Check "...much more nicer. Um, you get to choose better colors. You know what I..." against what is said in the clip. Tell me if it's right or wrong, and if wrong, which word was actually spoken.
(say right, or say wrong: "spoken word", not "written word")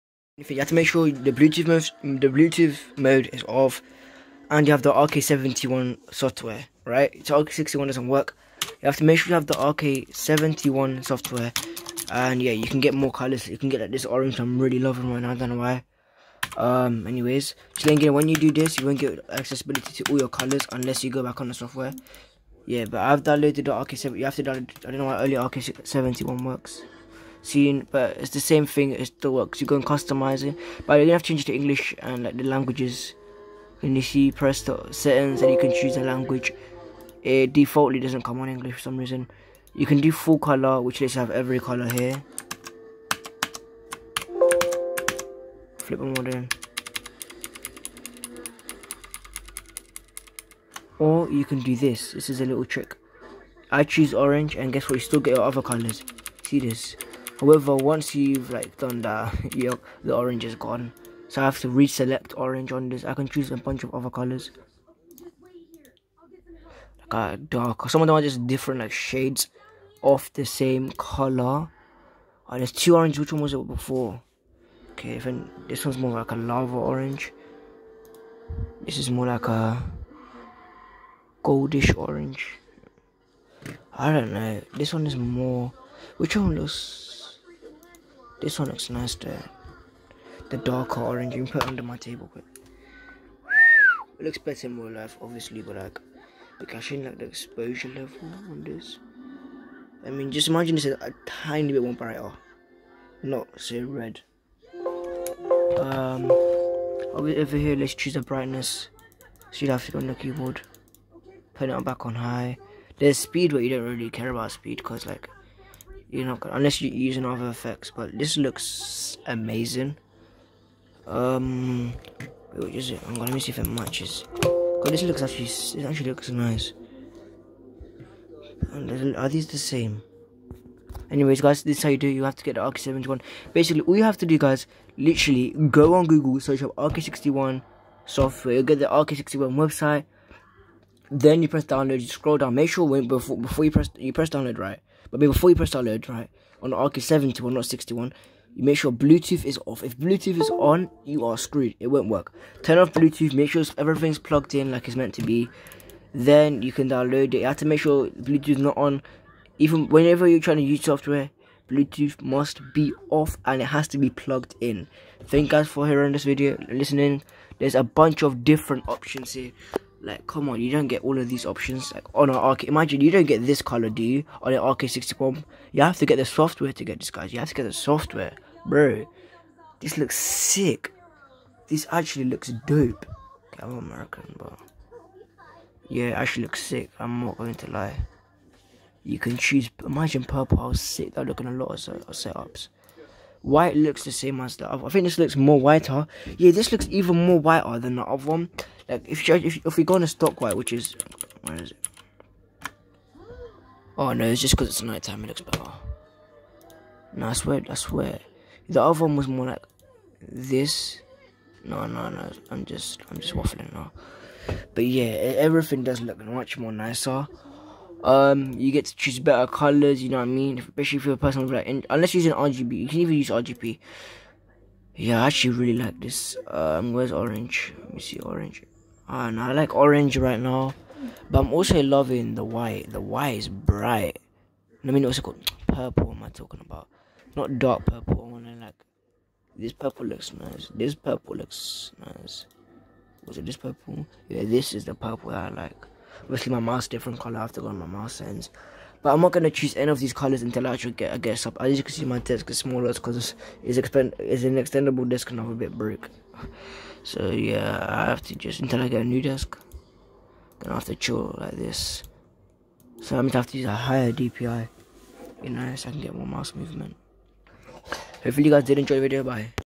right.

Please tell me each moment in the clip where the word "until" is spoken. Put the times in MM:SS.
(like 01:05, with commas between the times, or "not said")
04:10, 04:18.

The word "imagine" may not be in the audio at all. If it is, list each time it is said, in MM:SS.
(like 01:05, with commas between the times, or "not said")
01:40, 02:52, 03:09.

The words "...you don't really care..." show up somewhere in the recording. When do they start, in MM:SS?
01:53.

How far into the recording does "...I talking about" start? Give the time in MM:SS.
03:56.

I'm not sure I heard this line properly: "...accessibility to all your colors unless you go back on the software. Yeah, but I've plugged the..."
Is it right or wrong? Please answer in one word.
wrong.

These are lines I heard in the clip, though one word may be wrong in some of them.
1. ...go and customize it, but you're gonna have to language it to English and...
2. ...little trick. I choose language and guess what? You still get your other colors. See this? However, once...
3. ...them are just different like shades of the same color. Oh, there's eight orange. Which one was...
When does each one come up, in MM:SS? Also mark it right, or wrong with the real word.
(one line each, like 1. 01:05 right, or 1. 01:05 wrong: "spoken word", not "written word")
1. 00:29 wrong: "change", not "language"
2. 00:52 wrong: "orange", not "language"
3. 01:08 wrong: "two", not "eight".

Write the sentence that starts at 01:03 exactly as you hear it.
I can choose a bunch of other colors.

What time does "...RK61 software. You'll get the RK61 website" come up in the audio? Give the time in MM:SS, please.
02:16.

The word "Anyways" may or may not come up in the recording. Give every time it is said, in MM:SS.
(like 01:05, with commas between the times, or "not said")
00:17, 02:11.